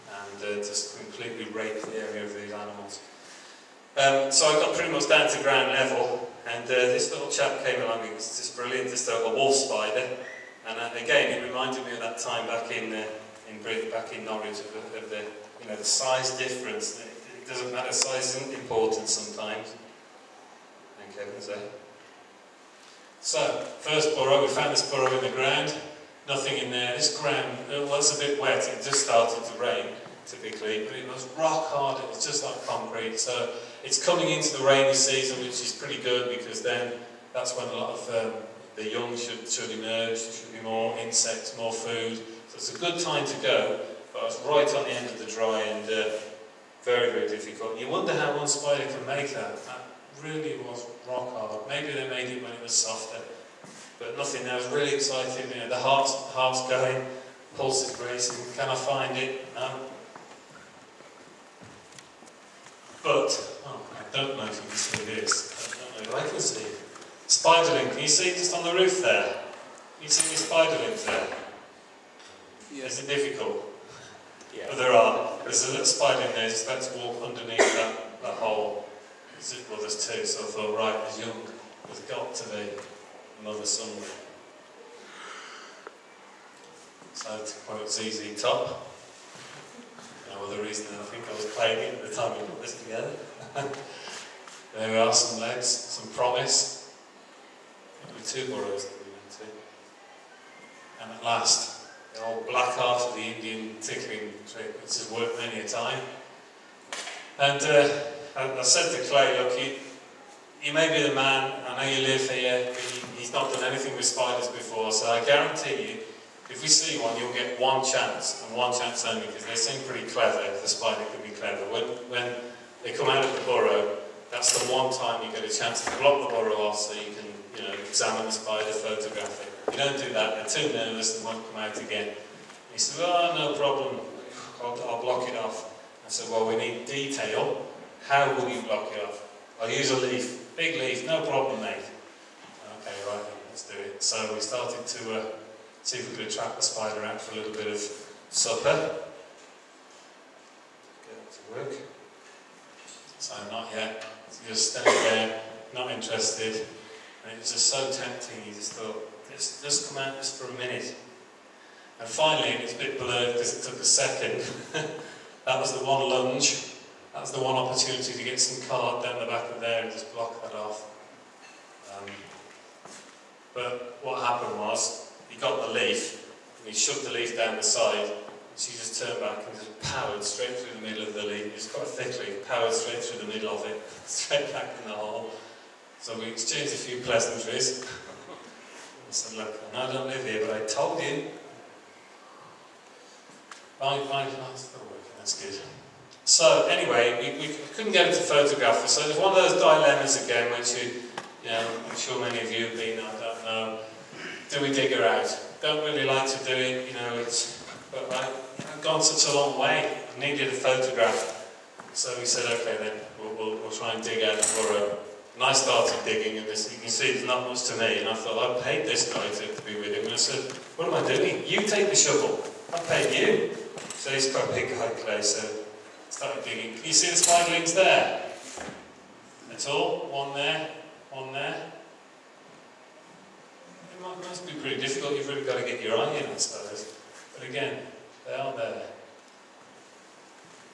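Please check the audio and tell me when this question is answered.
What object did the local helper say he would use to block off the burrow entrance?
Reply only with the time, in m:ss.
2:19.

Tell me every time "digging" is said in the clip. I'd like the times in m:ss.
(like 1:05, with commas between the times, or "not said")
3:36, 3:46.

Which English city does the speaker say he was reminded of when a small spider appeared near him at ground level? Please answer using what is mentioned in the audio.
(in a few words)
Norwich.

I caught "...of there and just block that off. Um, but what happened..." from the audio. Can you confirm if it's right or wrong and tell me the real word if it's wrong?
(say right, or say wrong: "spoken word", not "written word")
right.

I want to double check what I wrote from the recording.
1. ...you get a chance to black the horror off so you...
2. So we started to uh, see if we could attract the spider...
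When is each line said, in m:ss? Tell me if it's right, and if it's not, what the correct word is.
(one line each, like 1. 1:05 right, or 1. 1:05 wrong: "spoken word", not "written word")
1. 2:05 wrong: "block", not "black"
2. 2:24 right.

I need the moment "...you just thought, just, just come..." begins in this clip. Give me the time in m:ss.
2:38.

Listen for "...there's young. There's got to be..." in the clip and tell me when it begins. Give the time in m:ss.
1:21.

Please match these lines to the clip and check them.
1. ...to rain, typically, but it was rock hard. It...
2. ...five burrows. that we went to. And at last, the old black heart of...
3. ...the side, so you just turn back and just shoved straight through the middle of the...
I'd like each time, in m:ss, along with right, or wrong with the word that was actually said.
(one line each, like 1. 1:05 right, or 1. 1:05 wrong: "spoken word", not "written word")
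1. 0:29 right
2. 1:38 wrong: "two", not "five"
3. 2:57 wrong: "powered", not "shoved".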